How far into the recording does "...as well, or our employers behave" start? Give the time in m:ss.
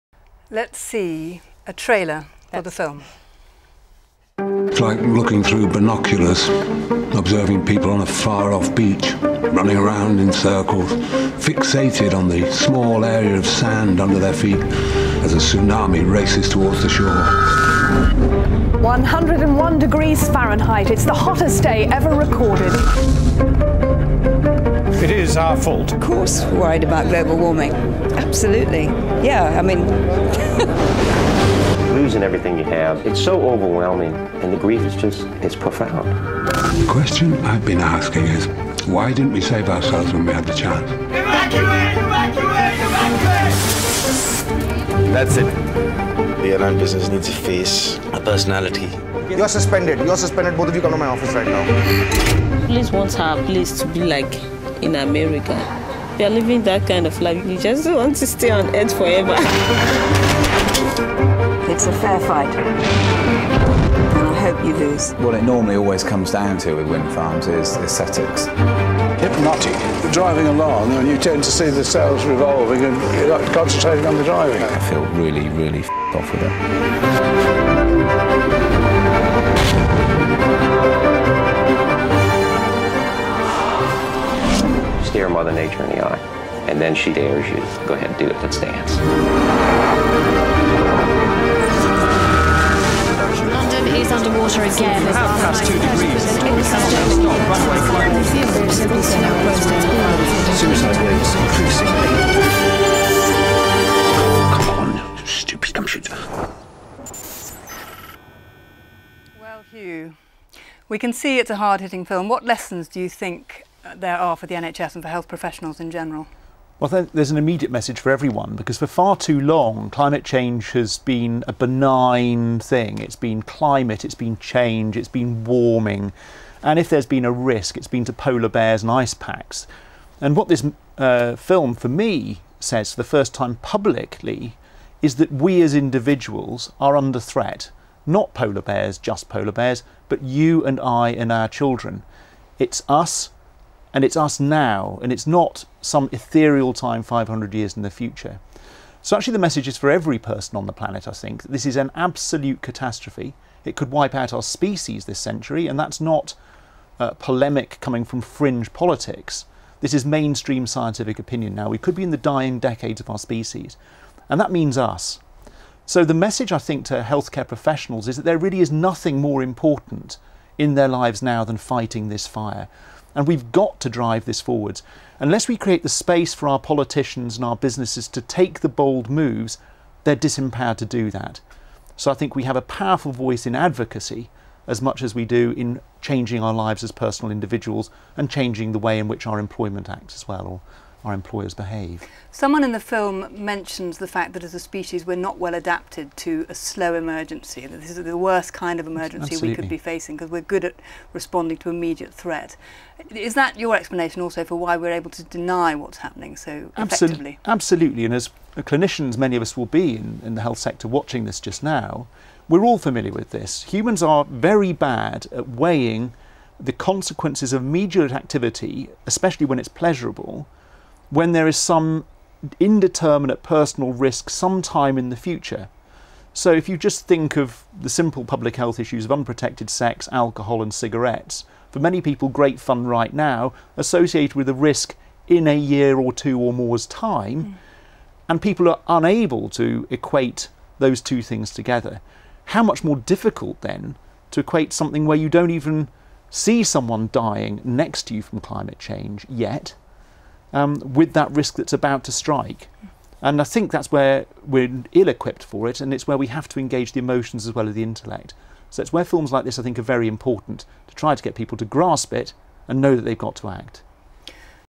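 3:10.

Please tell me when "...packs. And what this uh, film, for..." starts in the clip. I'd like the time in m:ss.
2:09.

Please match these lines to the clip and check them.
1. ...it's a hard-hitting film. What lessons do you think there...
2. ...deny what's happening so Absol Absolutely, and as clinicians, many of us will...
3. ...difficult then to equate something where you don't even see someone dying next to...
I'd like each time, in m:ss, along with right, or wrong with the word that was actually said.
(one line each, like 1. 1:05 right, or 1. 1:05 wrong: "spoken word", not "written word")
1. 1:51 right
2. 3:25 right
3. 4:02 right.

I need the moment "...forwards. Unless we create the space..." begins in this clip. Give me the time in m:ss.
2:54.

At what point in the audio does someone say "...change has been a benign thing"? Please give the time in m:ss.
2:00.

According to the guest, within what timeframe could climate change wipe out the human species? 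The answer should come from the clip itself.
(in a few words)
this century.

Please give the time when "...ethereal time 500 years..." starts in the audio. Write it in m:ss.
2:26.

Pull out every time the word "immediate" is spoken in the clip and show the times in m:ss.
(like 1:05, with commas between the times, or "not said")
1:57, 3:21, 3:37.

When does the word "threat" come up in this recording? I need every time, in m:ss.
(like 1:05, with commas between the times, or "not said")
2:17, 3:22.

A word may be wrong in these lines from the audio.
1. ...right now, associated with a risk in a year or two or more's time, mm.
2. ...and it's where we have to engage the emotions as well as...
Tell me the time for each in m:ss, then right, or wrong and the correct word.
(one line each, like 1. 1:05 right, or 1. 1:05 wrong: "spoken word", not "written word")
1. 3:52 right
2. 4:15 right.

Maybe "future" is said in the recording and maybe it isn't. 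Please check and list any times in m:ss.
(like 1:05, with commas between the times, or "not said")
2:27, 3:45.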